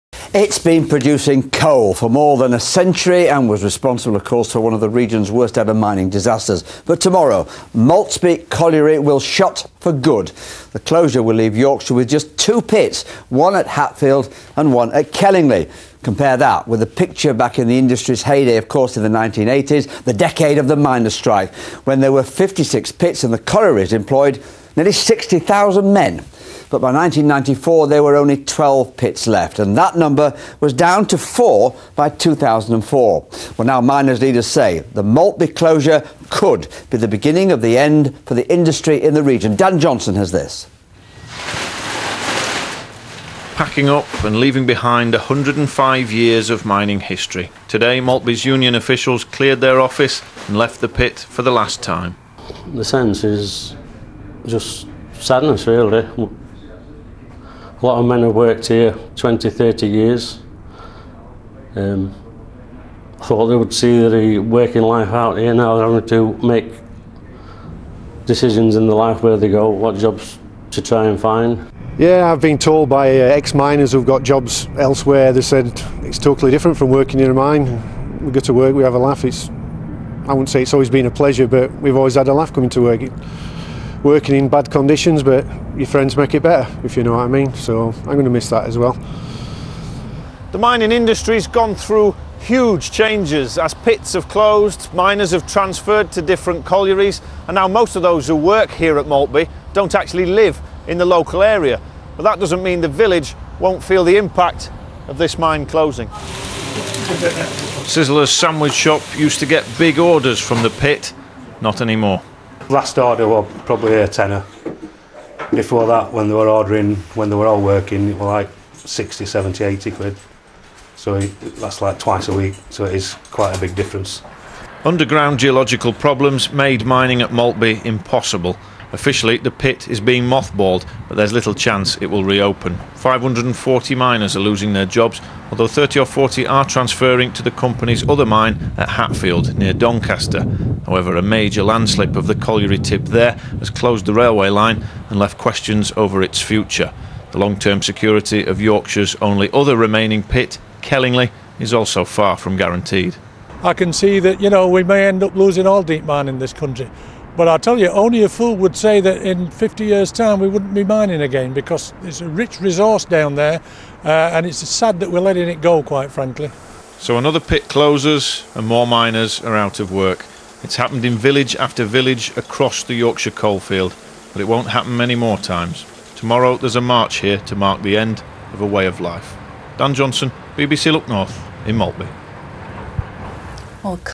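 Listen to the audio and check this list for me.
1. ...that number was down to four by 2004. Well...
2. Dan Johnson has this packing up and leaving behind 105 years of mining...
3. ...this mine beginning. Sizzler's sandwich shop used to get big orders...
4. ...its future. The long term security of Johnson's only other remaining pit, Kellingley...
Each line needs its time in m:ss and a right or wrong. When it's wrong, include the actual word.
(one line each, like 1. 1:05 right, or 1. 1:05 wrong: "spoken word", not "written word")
1. 0:29 right
2. 0:39 right
3. 1:45 wrong: "closing", not "beginning"
4. 2:26 wrong: "Yorkshire", not "Johnson".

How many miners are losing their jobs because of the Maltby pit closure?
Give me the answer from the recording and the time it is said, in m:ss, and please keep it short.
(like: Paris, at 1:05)
540, at 2:12.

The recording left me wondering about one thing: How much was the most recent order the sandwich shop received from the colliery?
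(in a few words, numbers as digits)
A tenner.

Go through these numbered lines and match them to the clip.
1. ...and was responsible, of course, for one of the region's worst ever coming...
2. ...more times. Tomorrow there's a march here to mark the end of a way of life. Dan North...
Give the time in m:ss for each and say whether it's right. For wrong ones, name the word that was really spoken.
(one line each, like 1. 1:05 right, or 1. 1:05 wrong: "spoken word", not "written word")
1. 0:03 wrong: "mining", not "coming"
2. 2:55 wrong: "Johnson", not "North".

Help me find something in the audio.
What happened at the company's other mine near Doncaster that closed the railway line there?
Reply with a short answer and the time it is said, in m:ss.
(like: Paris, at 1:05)
A major landslip, at 2:21.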